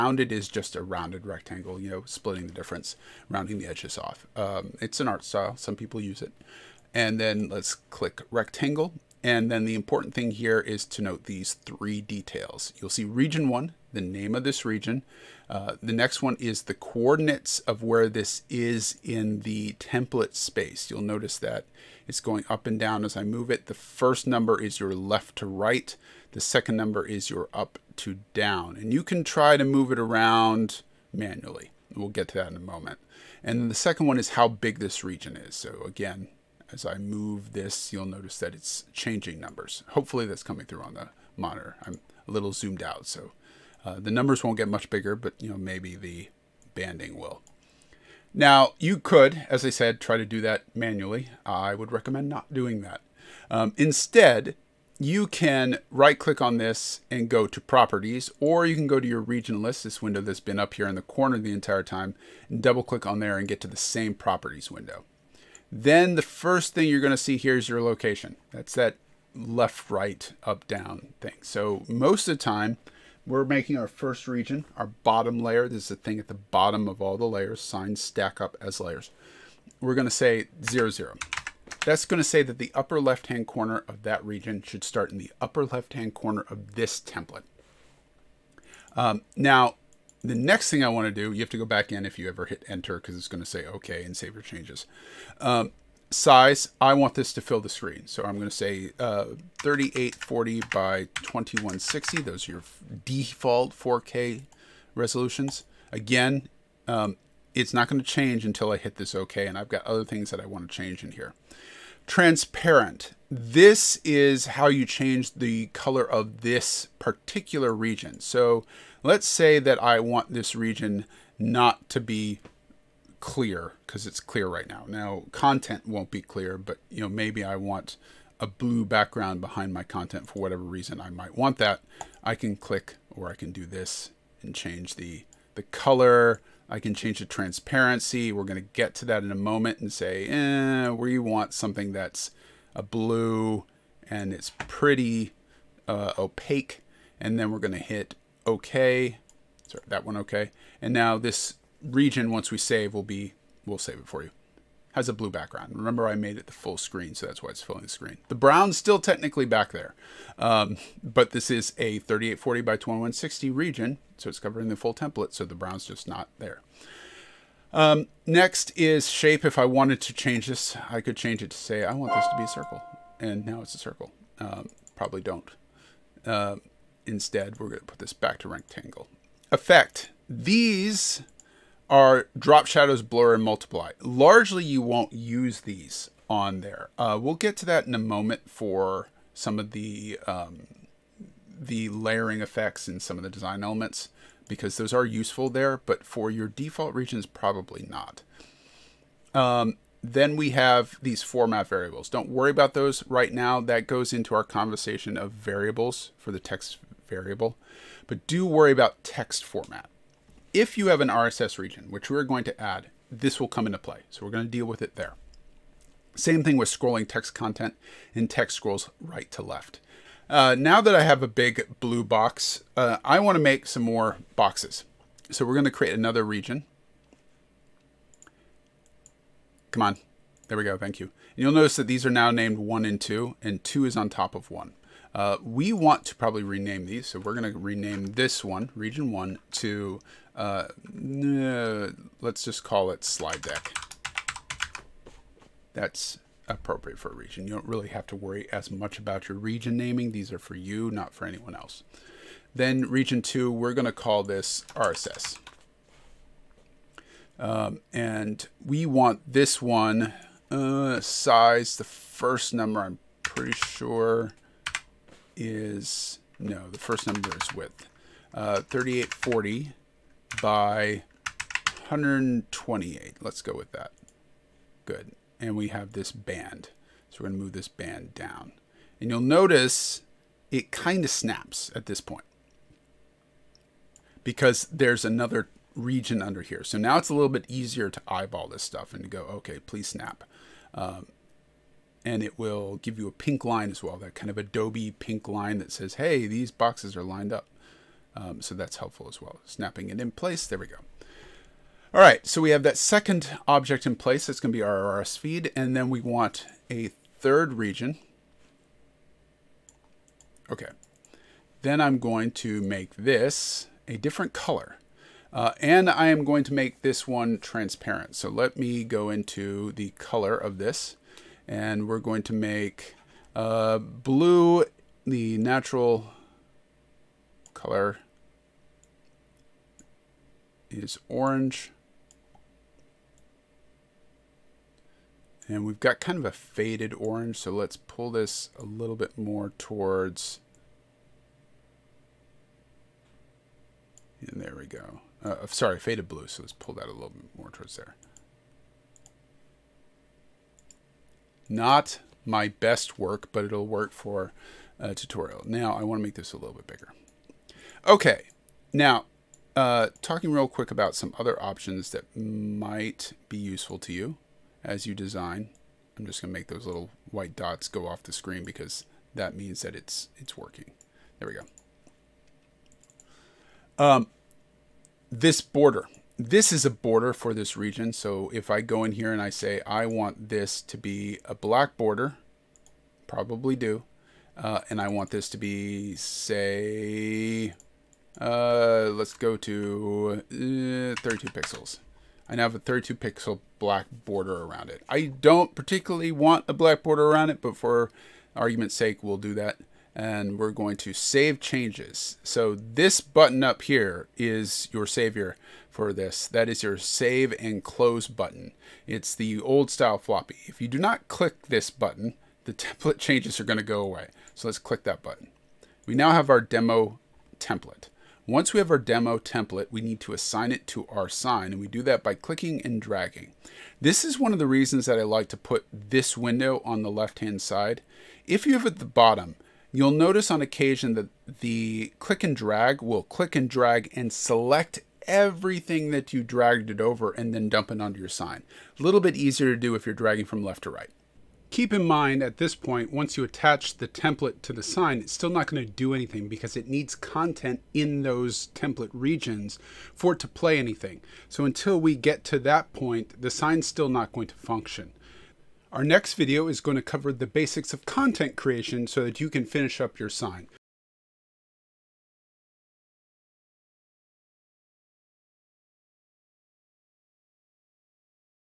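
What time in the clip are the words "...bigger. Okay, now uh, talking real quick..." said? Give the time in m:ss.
5:56.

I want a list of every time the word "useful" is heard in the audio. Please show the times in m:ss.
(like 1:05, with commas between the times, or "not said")
3:15, 6:03.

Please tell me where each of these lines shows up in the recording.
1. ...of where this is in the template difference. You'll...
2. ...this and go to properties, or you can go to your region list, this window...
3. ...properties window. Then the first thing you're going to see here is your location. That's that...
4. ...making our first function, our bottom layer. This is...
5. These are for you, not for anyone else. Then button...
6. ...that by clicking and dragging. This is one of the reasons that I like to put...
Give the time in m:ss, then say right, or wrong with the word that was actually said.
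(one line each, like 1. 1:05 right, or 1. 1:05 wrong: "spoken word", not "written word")
1. 0:17 wrong: "space", not "difference"
2. 0:56 right
3. 1:04 right
4. 1:13 wrong: "region", not "function"
5. 4:10 wrong: "region", not "button"
6. 7:01 right.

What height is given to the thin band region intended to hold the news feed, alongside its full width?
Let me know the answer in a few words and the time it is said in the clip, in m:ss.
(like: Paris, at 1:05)
128, at 4:31.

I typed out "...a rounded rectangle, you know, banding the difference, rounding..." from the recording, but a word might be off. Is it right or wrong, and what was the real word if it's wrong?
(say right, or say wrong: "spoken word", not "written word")
wrong: "splitting", not "banding".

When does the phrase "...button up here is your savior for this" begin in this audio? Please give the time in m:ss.
6:42.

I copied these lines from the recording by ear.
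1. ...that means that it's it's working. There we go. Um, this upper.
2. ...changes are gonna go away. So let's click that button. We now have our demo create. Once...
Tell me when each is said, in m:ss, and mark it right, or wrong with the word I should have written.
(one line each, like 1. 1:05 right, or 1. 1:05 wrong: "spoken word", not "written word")
1. 6:09 wrong: "border", not "upper"
2. 6:52 wrong: "template", not "create".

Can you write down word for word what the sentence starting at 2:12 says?
I can click or I can do this and change the the color, I can change the transparency.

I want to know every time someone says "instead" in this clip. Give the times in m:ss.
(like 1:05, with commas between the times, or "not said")
0:53, 2:57.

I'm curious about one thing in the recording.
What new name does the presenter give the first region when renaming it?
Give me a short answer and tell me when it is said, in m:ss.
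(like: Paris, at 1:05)
slide deck, at 4:03.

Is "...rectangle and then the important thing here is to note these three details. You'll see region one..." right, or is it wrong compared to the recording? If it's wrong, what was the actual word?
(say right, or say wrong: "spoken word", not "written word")
right.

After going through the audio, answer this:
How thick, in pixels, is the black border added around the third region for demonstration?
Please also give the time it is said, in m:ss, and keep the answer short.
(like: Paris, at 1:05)
32 pixels, at 6:31.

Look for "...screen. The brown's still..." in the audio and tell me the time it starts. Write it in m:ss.
2:37.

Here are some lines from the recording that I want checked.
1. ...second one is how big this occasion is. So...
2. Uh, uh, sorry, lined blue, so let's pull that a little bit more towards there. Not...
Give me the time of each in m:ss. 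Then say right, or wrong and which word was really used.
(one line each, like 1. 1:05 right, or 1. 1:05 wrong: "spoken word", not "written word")
1. 0:33 wrong: "region", not "occasion"
2. 5:45 wrong: "faded", not "lined".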